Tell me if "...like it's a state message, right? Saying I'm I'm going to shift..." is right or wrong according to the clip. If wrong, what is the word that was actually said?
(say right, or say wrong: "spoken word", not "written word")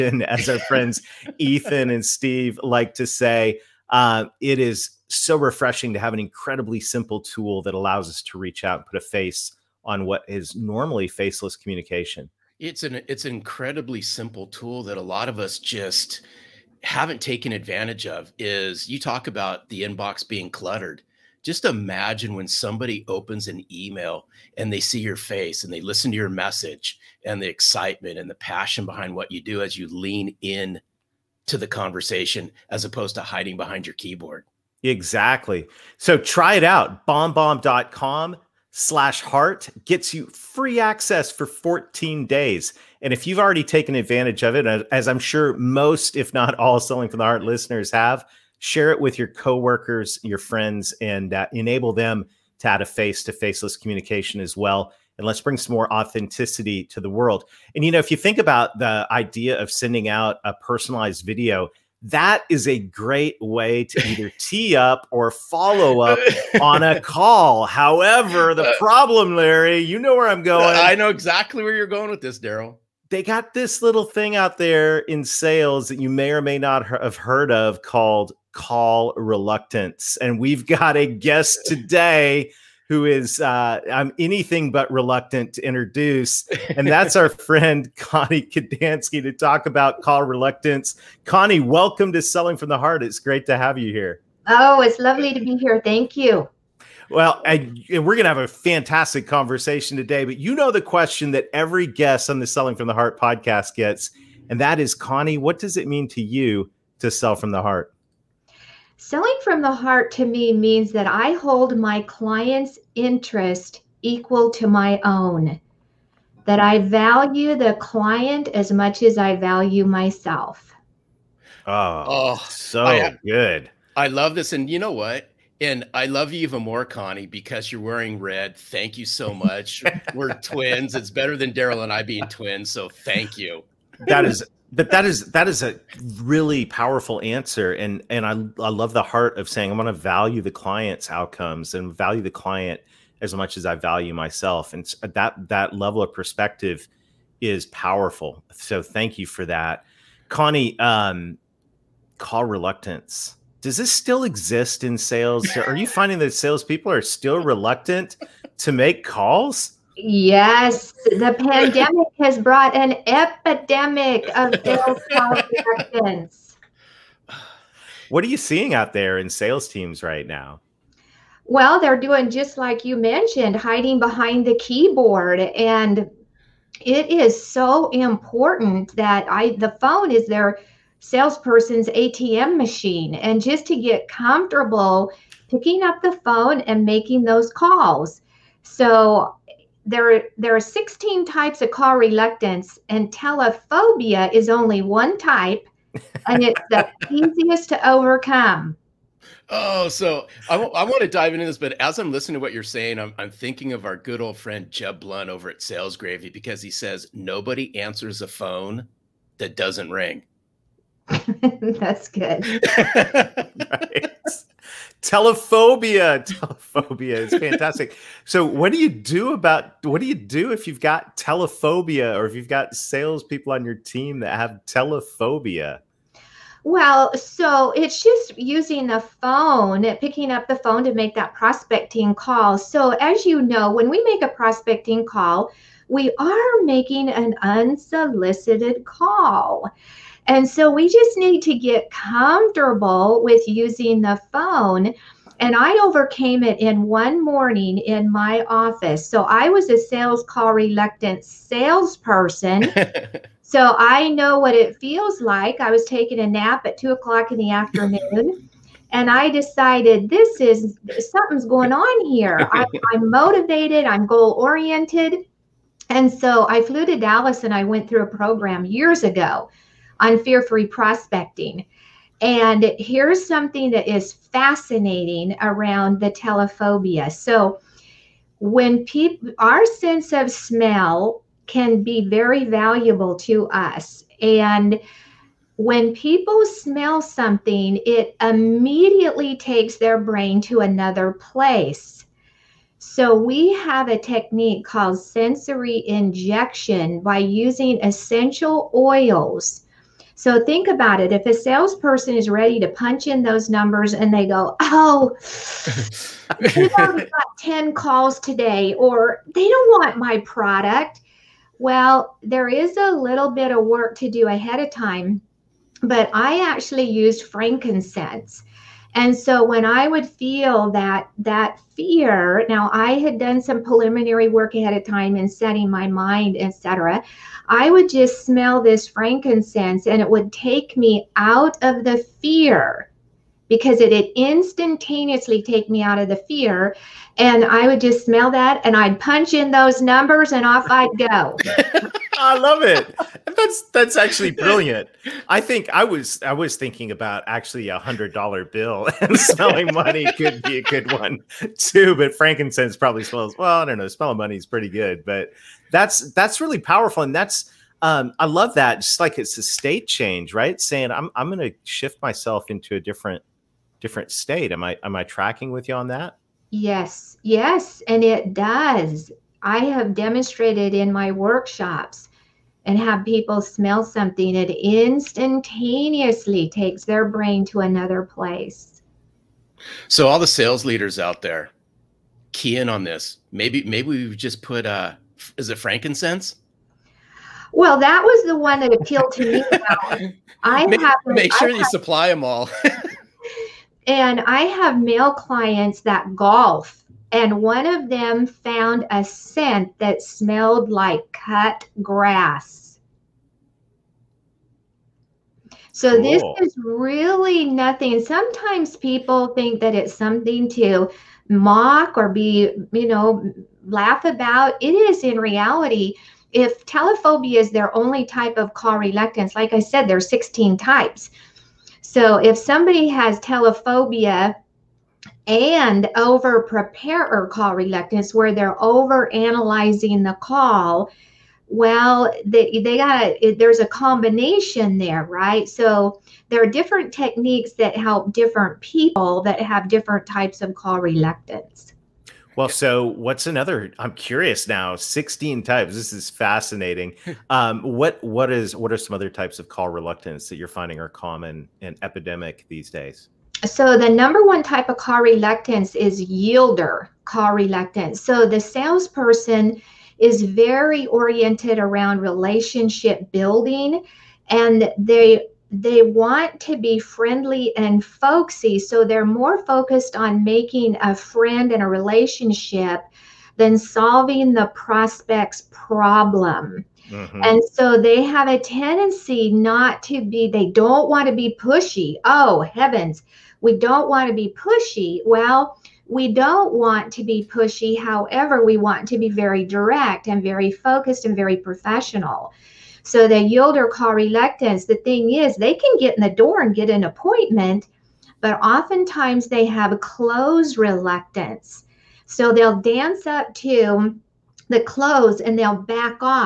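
wrong: "change", not "message".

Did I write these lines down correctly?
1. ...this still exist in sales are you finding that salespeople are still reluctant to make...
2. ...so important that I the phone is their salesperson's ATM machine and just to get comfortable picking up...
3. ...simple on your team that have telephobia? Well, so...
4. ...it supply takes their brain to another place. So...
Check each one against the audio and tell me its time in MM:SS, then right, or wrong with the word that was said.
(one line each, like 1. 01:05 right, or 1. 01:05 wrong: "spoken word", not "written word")
1. 02:33 right
2. 02:57 right
3. 03:42 wrong: "salespeople", not "simple"
4. 06:14 wrong: "instantaneously", not "supply".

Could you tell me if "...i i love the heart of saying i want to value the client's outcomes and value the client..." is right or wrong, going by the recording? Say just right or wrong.
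right.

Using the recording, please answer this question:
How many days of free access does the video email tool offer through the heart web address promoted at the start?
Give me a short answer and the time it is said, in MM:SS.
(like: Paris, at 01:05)
14, at 00:41.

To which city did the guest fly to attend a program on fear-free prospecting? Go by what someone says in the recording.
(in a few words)
Dallas.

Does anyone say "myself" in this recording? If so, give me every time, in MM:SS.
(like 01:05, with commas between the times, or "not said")
01:59, 02:24, 06:02.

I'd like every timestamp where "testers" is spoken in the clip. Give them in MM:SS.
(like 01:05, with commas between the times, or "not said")
not said.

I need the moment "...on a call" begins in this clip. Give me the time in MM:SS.
01:06.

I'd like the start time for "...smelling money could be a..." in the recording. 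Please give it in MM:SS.
05:49.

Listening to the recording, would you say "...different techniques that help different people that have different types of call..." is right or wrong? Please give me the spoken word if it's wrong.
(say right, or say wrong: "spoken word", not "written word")
right.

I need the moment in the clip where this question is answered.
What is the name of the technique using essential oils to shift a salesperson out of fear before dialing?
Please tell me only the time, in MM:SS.
04:54.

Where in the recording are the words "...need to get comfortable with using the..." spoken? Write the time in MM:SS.
04:01.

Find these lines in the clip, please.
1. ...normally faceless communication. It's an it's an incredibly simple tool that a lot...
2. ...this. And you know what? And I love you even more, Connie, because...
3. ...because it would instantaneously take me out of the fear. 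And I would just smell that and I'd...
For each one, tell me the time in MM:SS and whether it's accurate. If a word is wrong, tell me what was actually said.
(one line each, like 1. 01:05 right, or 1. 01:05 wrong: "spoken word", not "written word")
1. 00:10 right
2. 02:04 right
3. 05:33 right.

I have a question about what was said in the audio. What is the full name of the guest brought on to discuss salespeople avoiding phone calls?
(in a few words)
Connie Kadansky.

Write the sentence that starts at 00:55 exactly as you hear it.
And let's bring some more authenticity to the world.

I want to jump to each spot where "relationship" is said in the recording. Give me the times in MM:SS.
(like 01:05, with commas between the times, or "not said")
07:42, 07:51.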